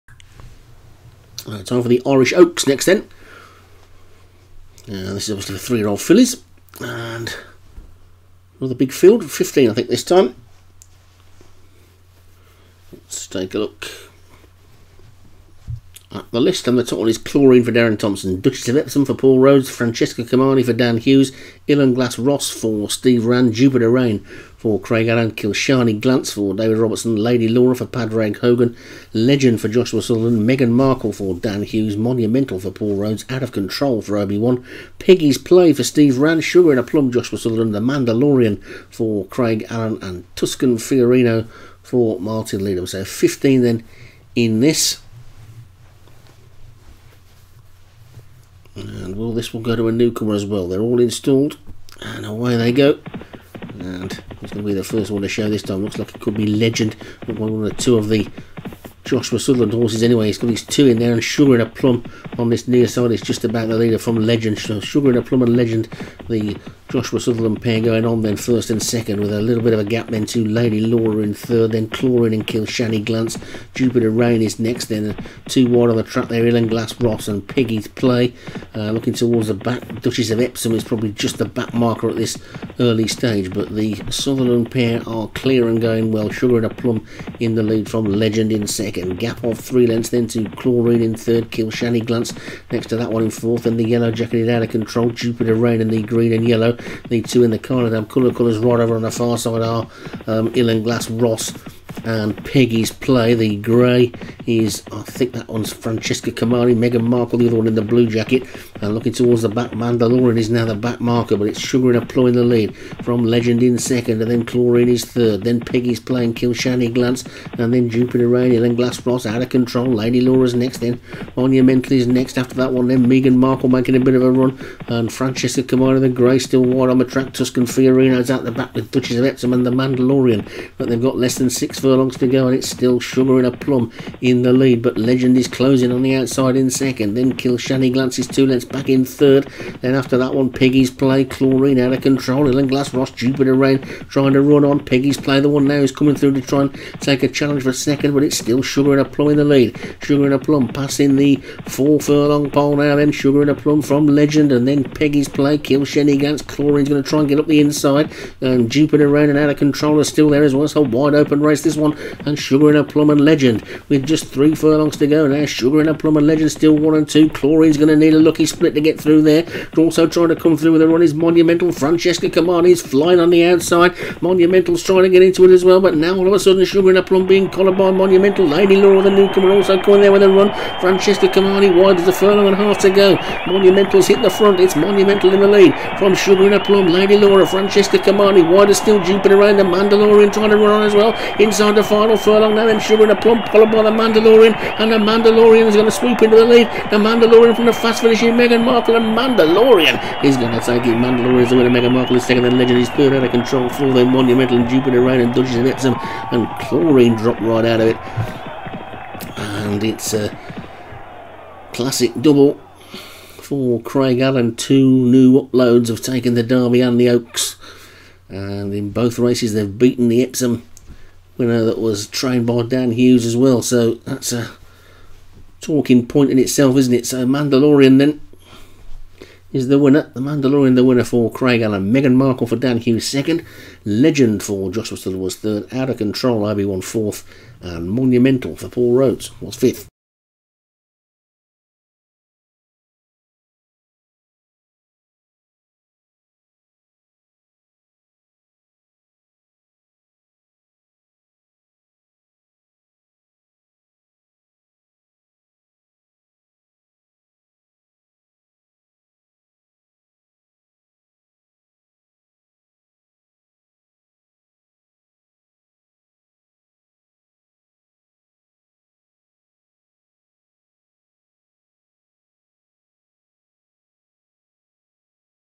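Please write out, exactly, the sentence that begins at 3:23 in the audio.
full then Monumental, and Jupiter Rain, and Dodges and Epsom, and Chlorine drop right out of it.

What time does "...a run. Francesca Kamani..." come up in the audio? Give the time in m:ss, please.
3:00.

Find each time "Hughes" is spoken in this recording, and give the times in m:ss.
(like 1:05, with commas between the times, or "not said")
0:20, 0:31, 3:42, 3:52.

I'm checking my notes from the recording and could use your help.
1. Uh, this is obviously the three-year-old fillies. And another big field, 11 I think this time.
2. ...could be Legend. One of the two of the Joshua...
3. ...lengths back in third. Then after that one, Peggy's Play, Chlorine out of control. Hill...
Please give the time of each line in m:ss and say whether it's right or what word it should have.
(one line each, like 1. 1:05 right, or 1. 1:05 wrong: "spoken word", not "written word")
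1. 0:04 wrong: "15", not "11"
2. 0:56 right
3. 2:18 right.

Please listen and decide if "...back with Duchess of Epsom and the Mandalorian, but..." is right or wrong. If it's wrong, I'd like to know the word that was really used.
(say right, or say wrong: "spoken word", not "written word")
right.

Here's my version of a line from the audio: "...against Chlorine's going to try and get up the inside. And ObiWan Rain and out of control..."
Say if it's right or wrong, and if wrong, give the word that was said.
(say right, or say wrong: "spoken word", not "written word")
wrong: "Jupiter", not "ObiWan".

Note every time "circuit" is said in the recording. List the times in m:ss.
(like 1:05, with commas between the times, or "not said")
not said.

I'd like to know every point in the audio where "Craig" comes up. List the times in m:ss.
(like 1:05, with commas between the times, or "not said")
0:24, 0:39, 3:33, 3:51.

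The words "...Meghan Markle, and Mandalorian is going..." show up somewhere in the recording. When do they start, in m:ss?
3:18.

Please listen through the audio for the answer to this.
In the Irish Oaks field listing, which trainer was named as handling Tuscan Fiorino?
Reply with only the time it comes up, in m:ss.
0:42.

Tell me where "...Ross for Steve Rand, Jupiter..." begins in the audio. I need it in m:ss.
0:22.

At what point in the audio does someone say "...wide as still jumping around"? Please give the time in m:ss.
3:08.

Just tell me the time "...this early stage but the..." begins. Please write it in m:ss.
1:22.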